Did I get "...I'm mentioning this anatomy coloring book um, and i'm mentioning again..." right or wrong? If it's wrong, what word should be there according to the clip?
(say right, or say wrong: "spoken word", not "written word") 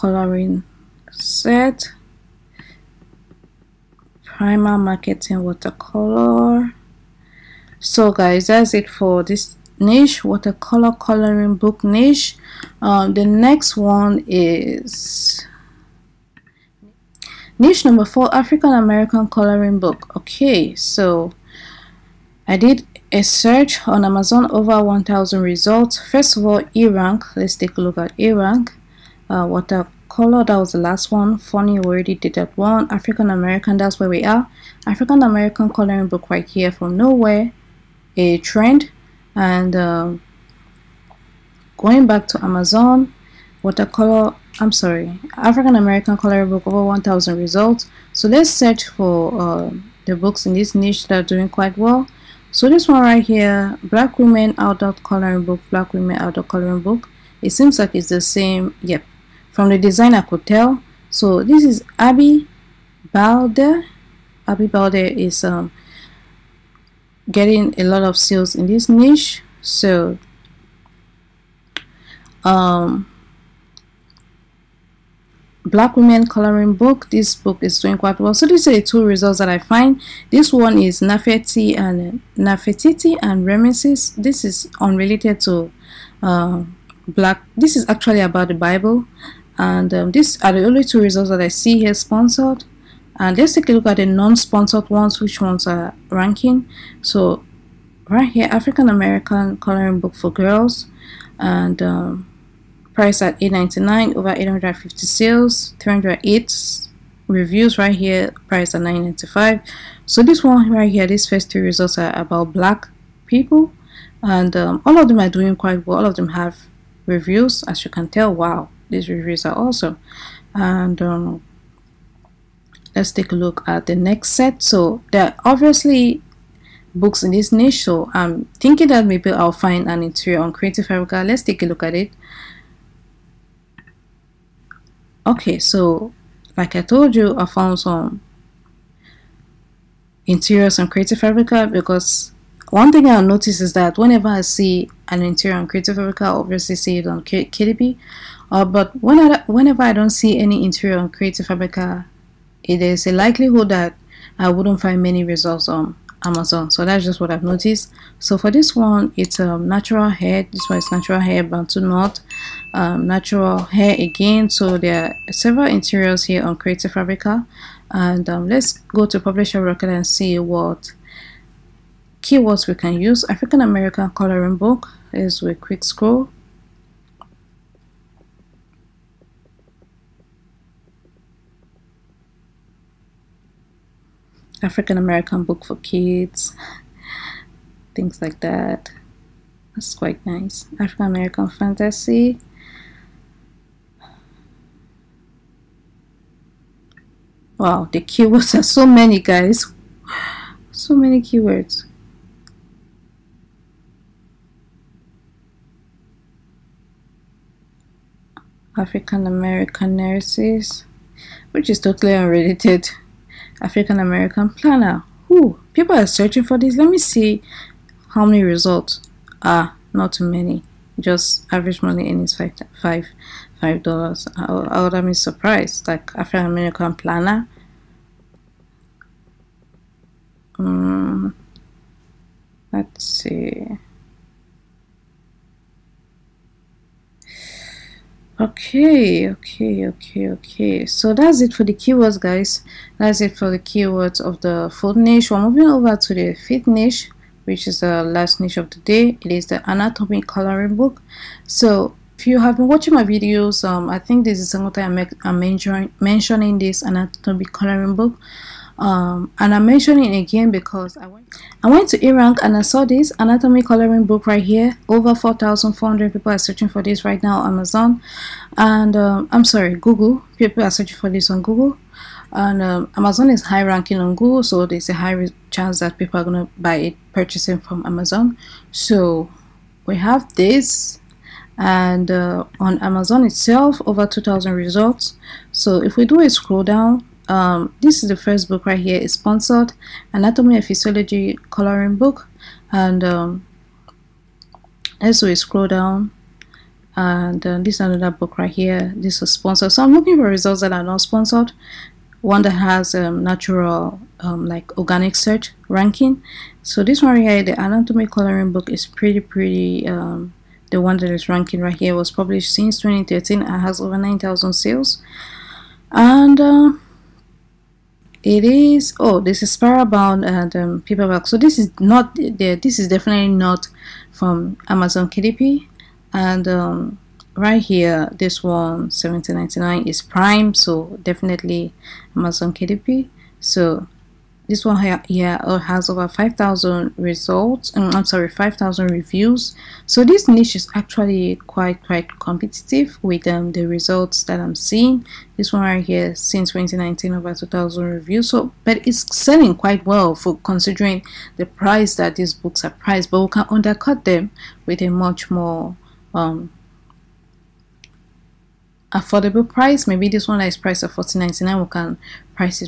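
right.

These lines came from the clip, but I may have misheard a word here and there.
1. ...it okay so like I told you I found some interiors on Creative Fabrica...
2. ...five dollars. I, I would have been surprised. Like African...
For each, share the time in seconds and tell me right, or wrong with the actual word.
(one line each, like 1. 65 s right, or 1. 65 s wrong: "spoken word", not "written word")
1. 131 s right
2. 223 s right.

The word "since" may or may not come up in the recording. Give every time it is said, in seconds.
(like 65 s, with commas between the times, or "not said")
312 s, 346 s.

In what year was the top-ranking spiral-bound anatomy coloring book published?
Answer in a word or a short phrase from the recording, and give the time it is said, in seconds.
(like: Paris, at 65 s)
2013, at 312 s.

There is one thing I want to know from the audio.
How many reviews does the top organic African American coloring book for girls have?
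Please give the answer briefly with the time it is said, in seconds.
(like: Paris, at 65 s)
308, at 105 s.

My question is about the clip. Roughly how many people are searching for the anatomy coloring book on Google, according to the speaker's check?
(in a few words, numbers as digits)
4,400.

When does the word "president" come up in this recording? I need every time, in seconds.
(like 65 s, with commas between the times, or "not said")
not said.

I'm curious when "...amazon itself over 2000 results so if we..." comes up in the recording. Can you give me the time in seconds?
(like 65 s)
282 s.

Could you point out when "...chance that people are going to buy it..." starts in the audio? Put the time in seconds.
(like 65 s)
275 s.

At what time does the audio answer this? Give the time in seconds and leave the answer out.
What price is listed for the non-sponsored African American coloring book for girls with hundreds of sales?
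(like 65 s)
103 s.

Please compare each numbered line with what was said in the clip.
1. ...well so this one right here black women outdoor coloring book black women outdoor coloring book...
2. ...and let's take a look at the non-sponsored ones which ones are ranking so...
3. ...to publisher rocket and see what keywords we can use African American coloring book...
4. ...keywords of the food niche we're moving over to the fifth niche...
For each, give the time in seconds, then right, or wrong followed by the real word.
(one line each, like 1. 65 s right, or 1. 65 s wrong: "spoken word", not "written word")
1. 51 s right
2. 93 s right
3. 169 s right
4. 243 s right.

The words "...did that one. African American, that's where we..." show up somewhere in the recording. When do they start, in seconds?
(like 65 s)
32 s.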